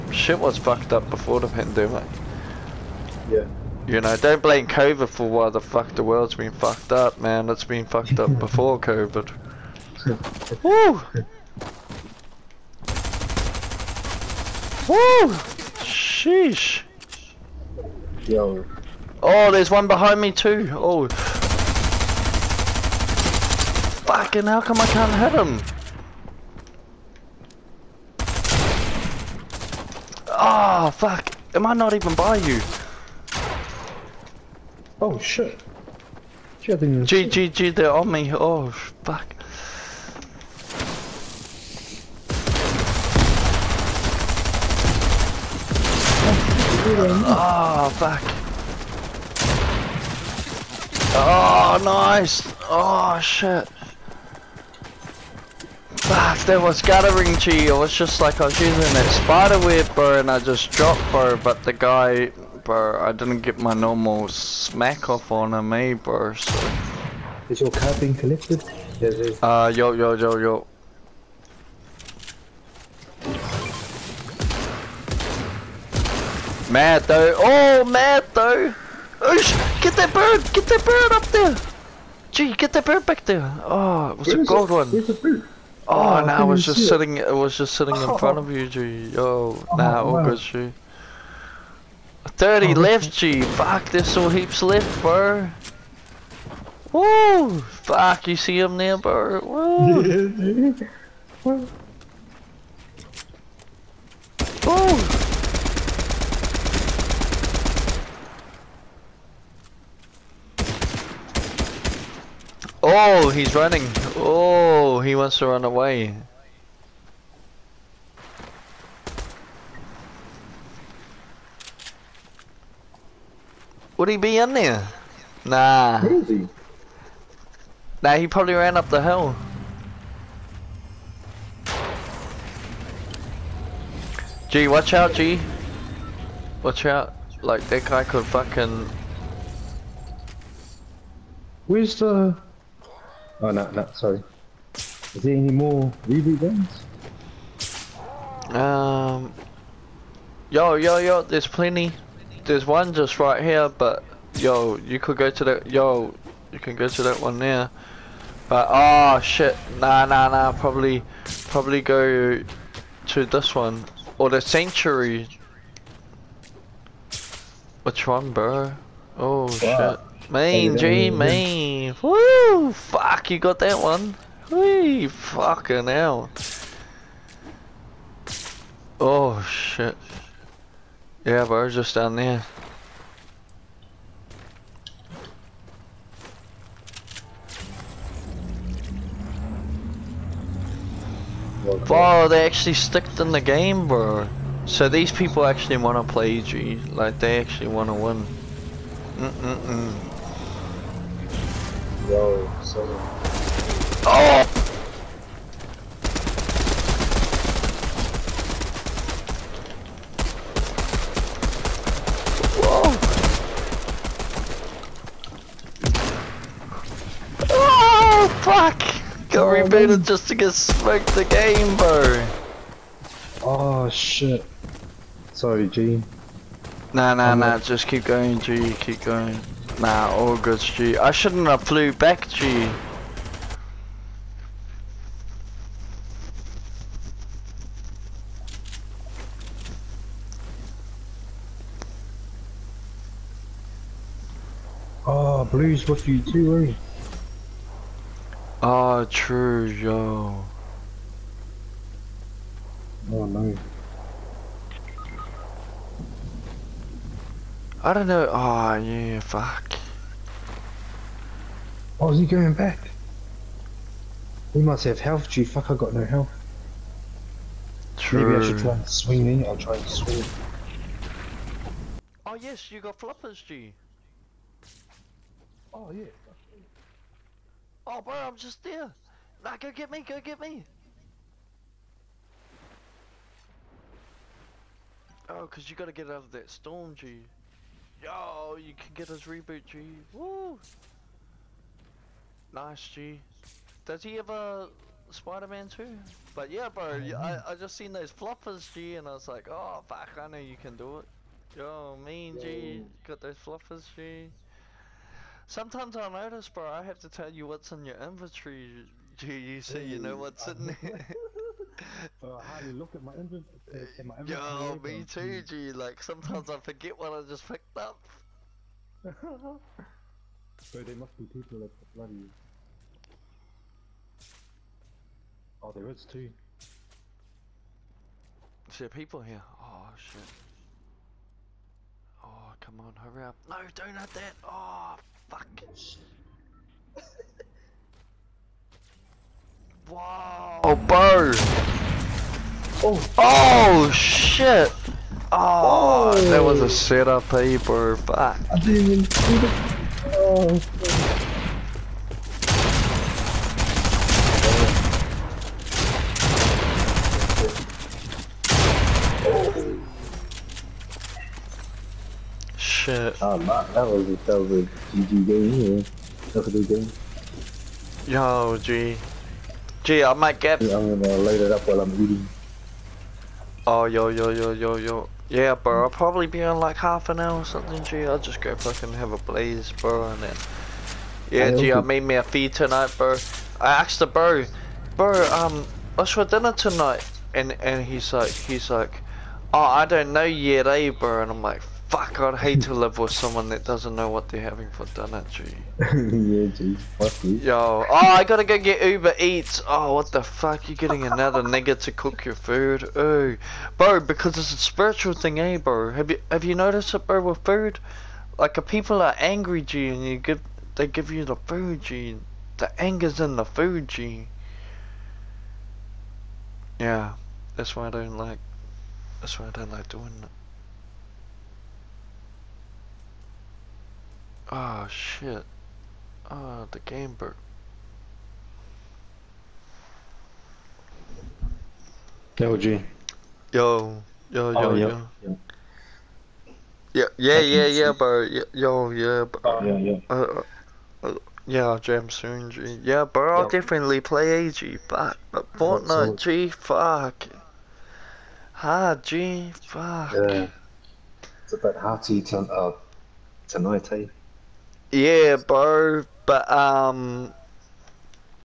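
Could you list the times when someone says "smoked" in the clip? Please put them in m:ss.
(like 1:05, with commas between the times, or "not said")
3:40.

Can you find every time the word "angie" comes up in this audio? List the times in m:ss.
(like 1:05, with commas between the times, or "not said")
not said.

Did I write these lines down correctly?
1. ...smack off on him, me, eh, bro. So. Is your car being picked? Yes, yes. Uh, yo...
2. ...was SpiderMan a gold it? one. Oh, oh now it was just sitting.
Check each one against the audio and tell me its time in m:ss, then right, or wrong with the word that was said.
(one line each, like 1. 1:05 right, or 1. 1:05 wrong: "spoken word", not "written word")
1. 1:04 wrong: "collected", not "picked"
2. 1:24 wrong: "Where", not "SpiderMan".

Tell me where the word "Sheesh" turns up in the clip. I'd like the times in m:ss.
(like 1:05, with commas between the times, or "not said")
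0:15.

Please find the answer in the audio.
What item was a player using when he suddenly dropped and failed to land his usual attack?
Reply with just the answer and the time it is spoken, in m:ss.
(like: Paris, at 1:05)
Spider web, at 0:59.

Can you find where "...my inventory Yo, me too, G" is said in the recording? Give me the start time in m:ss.
5:14.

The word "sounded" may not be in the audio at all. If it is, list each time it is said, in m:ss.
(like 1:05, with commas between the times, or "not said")
not said.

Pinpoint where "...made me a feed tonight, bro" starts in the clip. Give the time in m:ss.
6:21.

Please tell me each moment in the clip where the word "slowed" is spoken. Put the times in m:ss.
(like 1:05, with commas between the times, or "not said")
not said.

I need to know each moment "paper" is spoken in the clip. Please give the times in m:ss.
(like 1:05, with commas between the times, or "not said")
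5:47.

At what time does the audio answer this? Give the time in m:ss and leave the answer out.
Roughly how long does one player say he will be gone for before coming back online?
6:16.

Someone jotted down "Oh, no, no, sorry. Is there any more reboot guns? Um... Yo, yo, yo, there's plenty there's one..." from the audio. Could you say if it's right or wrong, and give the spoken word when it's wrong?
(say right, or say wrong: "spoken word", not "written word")
right.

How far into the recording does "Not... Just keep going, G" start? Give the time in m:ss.
3:47.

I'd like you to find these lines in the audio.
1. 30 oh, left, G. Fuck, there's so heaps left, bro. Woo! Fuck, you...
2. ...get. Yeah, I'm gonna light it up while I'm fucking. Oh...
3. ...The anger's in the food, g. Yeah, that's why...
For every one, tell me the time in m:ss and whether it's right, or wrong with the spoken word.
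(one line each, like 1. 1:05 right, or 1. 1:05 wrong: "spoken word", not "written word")
1. 1:32 right
2. 6:10 wrong: "eating", not "fucking"
3. 6:52 right.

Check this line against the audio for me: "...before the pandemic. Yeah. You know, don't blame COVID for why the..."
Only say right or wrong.
right.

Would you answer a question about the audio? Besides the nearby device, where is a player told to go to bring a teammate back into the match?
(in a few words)
The sanctuary.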